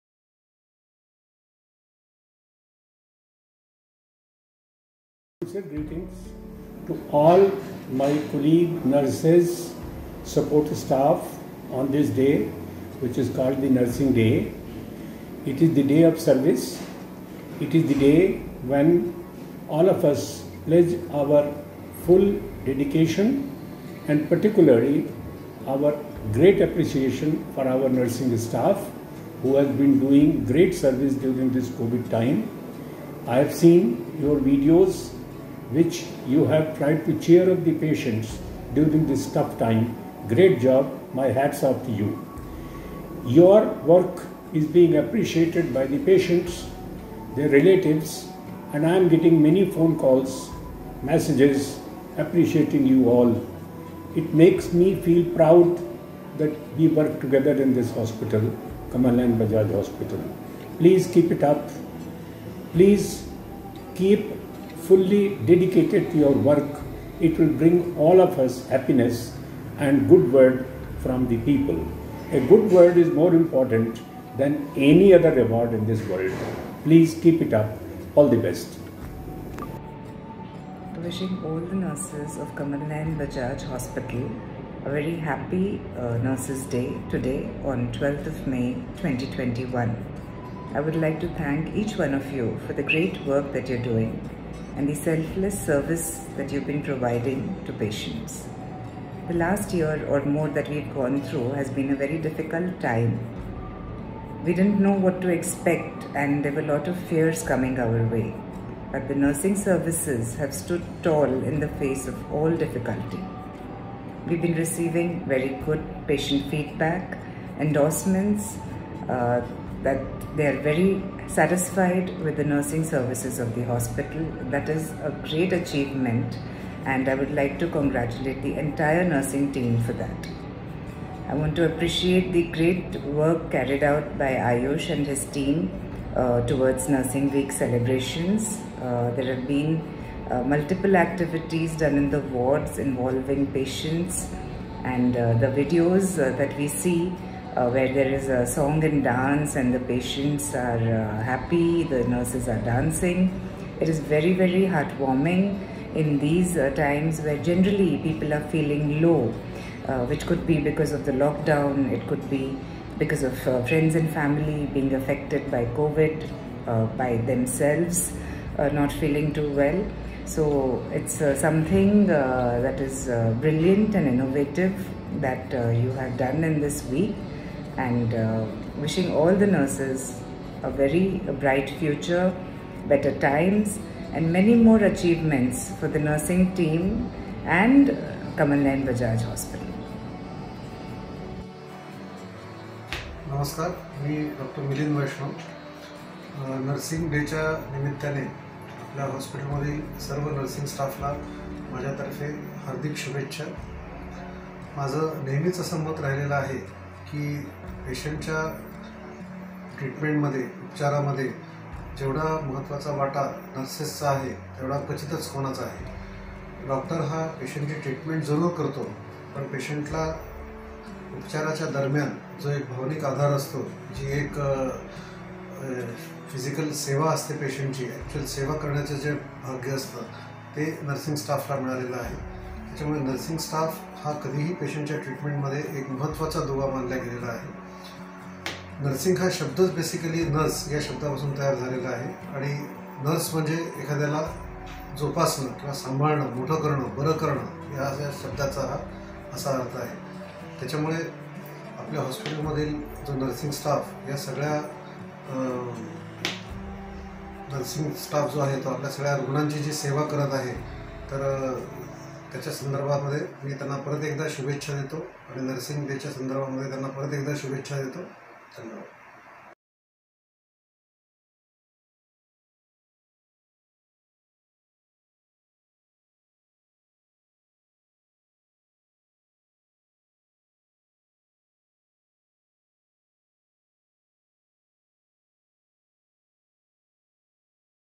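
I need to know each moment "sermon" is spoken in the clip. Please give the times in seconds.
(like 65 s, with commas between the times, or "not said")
not said.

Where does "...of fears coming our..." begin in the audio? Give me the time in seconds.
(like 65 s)
106 s.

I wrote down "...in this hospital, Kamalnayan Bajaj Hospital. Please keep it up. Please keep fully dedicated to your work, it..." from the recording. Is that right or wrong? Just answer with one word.
right.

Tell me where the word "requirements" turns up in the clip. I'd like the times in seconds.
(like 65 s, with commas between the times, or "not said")
not said.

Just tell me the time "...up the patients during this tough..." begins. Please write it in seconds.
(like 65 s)
37 s.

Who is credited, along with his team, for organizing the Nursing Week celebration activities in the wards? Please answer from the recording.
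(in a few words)
Ayush.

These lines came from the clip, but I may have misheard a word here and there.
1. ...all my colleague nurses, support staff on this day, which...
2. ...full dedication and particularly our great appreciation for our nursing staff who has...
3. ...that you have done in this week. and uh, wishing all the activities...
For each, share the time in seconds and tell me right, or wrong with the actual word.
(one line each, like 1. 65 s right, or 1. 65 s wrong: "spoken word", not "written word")
1. 7 s right
2. 22 s right
3. 175 s wrong: "nurses", not "activities".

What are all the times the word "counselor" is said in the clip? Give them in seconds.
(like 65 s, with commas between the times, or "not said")
not said.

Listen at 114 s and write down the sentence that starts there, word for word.
We've been receiving very good patient feedback, endorsements, uh, that they are very satisfied with the nursing services of the hospital.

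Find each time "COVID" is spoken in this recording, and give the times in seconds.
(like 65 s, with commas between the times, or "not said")
31 s, 165 s.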